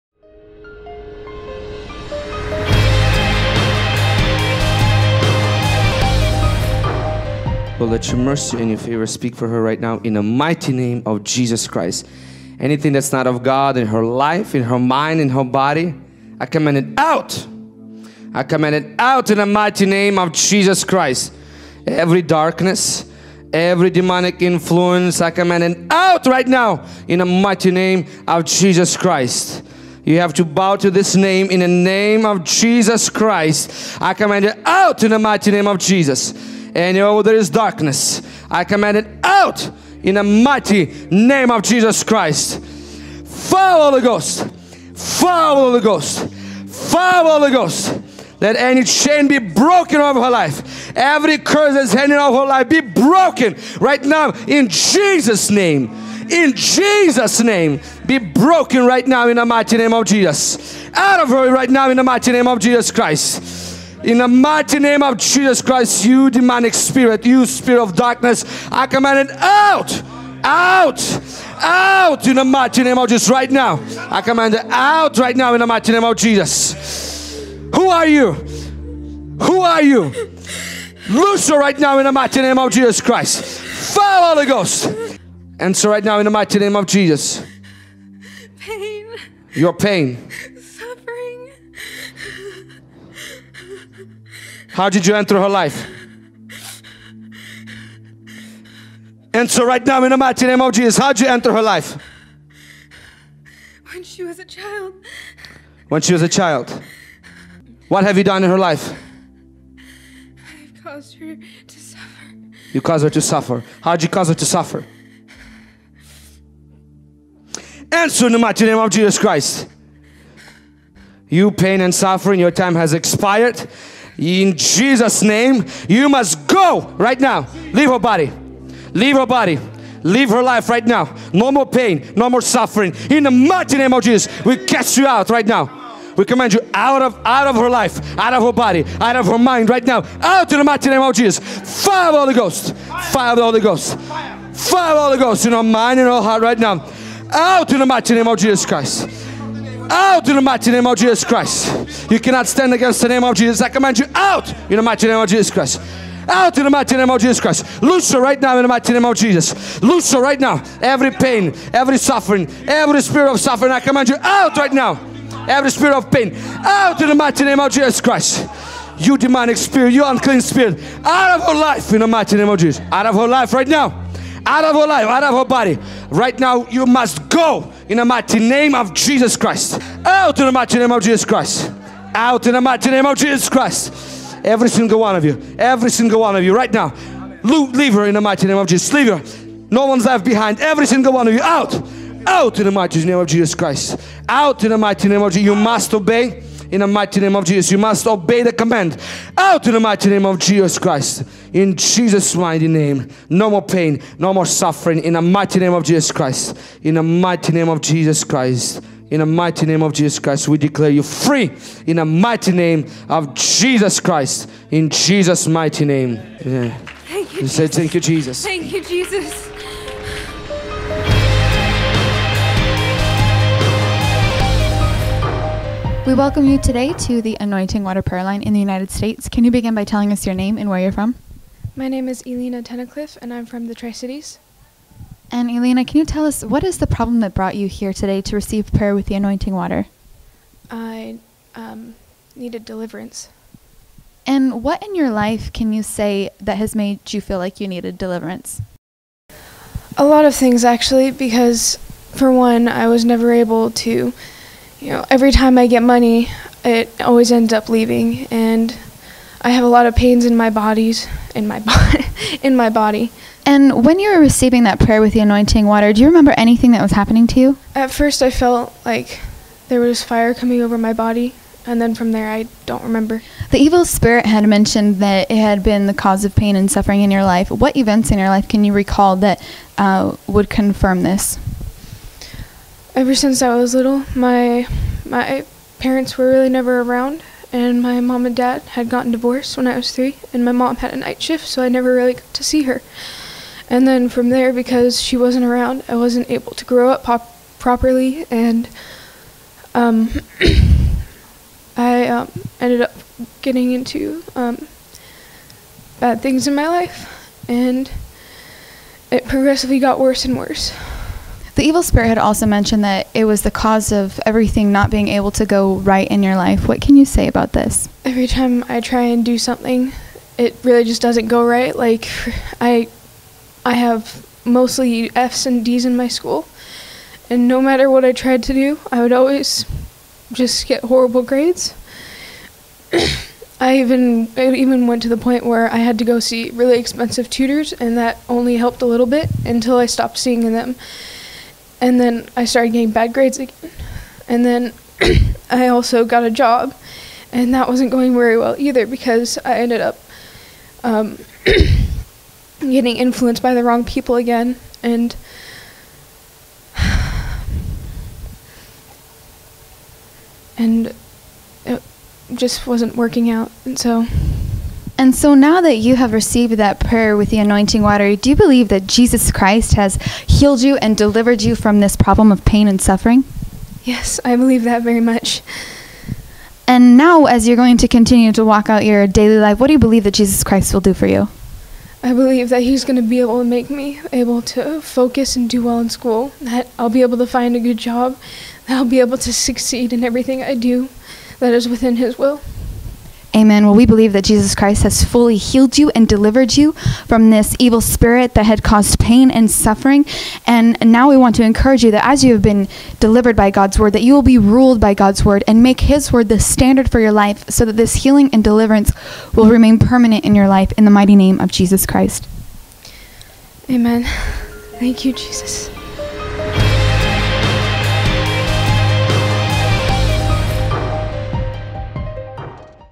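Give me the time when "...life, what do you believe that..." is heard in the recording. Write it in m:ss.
6:19.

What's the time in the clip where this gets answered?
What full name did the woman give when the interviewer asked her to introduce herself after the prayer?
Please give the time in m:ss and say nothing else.
3:52.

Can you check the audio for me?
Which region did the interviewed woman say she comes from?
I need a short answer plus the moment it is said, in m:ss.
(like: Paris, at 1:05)
Tri Cities, at 3:53.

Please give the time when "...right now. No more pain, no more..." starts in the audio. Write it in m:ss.
2:10.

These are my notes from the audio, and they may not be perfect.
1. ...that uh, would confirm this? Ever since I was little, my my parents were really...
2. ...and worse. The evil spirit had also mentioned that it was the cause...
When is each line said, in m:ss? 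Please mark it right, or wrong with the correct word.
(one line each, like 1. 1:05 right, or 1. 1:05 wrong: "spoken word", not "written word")
1. 4:39 right
2. 5:10 right.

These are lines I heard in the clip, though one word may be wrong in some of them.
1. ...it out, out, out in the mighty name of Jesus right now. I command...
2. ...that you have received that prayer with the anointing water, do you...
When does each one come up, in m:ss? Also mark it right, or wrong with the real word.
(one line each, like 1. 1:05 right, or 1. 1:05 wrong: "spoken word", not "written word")
1. 1:09 right
2. 6:05 right.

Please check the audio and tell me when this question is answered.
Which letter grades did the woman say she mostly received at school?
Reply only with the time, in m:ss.
5:25.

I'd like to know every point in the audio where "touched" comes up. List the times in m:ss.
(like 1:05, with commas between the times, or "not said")
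not said.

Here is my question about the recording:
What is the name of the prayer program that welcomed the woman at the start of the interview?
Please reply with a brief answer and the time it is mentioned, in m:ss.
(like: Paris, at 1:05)
Anointing Water Prayer Line, at 3:47.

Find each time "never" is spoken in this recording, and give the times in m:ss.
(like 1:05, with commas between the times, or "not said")
4:13, 4:46, 4:51.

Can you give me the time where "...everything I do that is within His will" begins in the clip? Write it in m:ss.
6:30.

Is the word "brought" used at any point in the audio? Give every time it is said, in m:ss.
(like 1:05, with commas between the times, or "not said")
3:57.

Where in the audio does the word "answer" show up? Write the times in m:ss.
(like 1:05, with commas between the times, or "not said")
1:25, 1:57.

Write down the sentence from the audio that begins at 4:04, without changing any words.
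And what in your life can you say that has made you feel like you needed deliverance?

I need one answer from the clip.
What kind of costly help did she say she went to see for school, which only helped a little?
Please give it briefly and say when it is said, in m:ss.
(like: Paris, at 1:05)
Expensive tutors, at 5:36.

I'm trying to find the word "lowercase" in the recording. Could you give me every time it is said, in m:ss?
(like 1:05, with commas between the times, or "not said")
not said.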